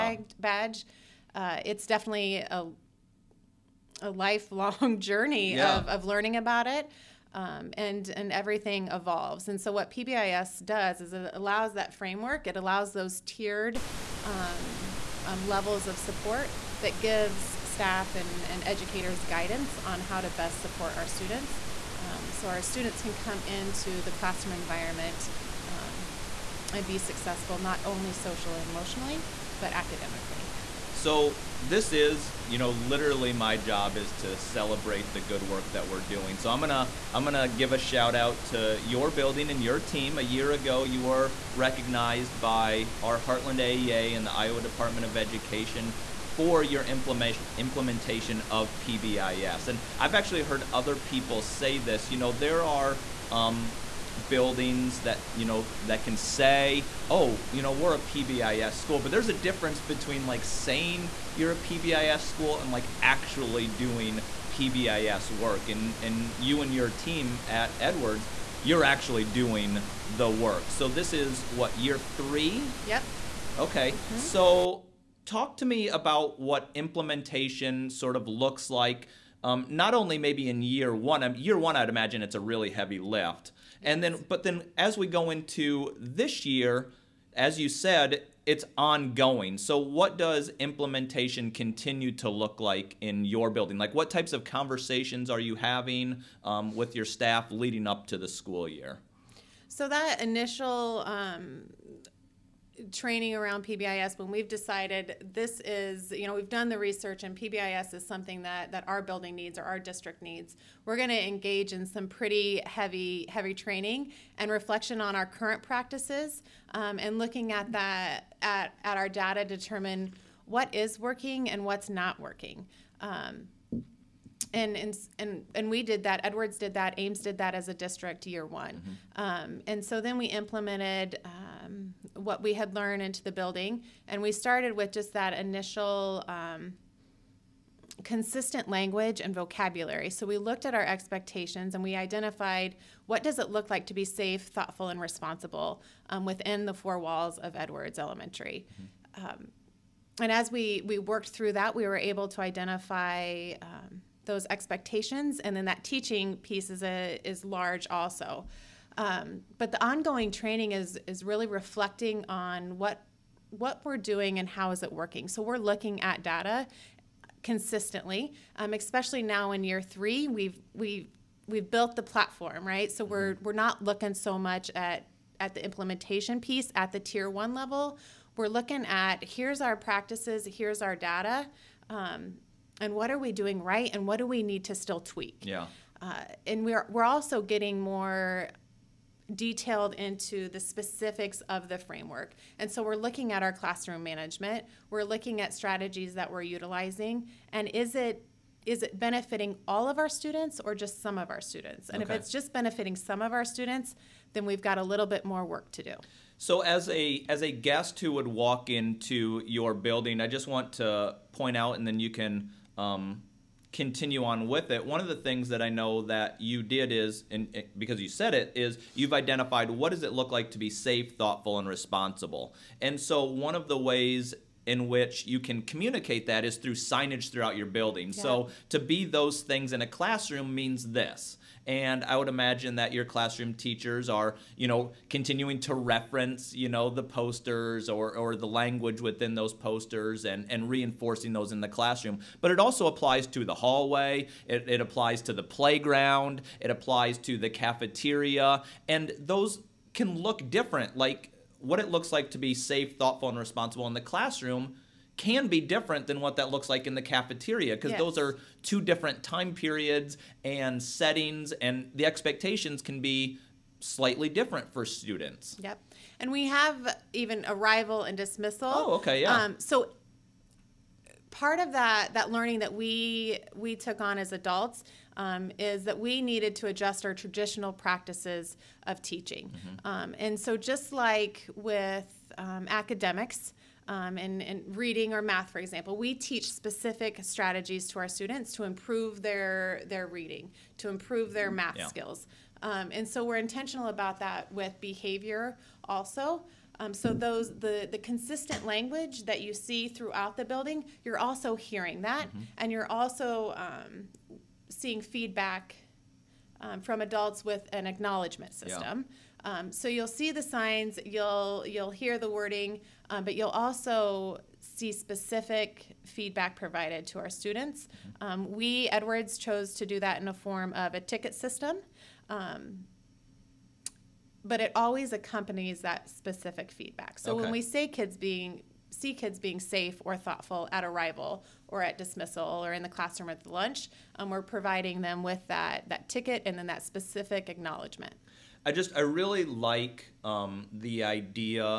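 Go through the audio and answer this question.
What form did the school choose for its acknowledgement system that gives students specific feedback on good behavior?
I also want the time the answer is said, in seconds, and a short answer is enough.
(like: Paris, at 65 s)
a ticket system, at 320 s.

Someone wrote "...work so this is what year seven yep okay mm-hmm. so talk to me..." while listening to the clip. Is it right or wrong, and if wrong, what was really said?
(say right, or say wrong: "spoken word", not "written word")
wrong: "three", not "seven".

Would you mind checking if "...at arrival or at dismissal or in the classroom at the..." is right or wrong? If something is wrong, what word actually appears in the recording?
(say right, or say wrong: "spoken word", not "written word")
right.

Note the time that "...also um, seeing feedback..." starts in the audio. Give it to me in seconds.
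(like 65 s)
302 s.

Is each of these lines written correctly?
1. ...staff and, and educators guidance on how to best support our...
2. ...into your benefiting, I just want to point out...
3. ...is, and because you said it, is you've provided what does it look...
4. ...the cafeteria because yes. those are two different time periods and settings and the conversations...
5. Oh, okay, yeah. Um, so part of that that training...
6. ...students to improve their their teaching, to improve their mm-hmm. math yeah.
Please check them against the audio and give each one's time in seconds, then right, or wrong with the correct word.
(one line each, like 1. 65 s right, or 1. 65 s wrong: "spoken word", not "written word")
1. 17 s right
2. 208 s wrong: "building", not "benefiting"
3. 216 s wrong: "identified", not "provided"
4. 256 s wrong: "expectations", not "conversations"
5. 268 s wrong: "learning", not "training"
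6. 288 s wrong: "reading", not "teaching".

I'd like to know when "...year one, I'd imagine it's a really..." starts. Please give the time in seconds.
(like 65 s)
81 s.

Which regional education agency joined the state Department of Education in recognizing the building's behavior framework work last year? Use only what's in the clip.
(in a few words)
Heartland AEA.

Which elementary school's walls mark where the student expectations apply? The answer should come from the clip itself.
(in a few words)
Edwards Elementary.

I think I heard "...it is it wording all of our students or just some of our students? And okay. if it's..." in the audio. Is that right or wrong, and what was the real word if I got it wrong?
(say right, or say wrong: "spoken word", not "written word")
wrong: "benefiting", not "wording".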